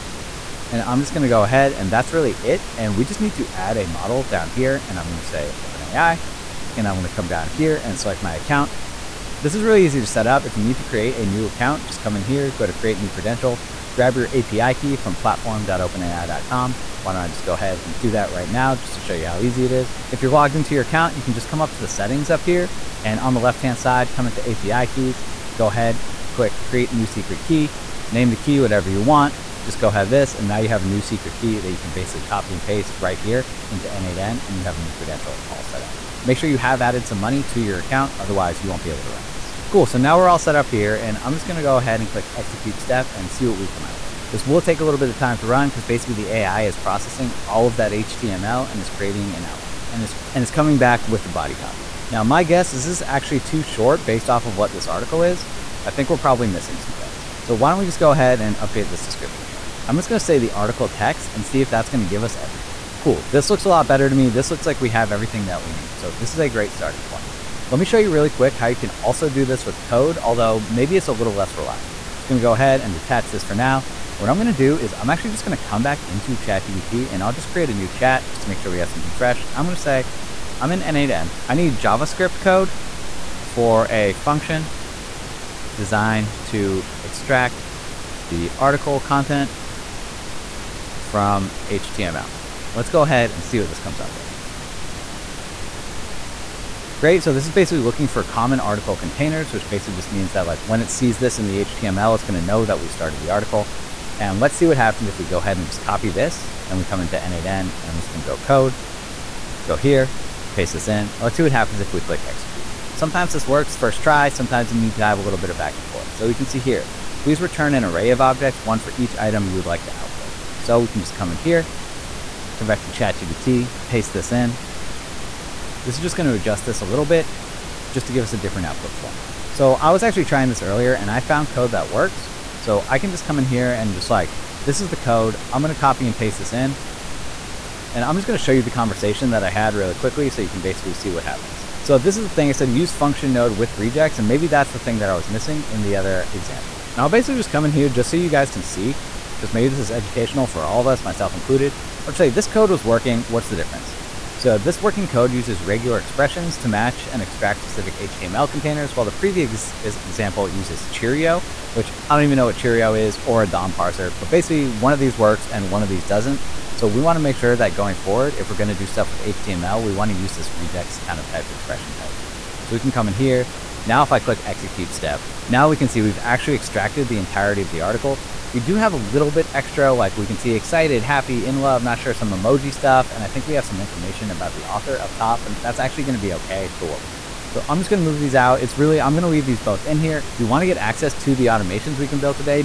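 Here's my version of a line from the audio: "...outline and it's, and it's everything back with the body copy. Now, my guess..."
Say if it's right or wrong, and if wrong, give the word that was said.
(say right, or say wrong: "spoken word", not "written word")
wrong: "coming", not "everything".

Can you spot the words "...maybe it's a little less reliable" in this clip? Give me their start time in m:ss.
1:10.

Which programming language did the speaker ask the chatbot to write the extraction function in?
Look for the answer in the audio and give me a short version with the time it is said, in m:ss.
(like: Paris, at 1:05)
JavaScript, at 1:21.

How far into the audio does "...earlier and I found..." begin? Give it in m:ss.
2:10.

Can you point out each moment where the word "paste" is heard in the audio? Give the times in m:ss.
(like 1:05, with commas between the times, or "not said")
0:32, 1:50, 2:03, 2:16.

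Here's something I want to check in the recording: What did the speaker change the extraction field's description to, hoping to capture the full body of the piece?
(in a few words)
the article text.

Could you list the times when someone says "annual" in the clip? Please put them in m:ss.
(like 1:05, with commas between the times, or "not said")
not said.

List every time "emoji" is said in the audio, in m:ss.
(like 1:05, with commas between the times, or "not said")
3:02.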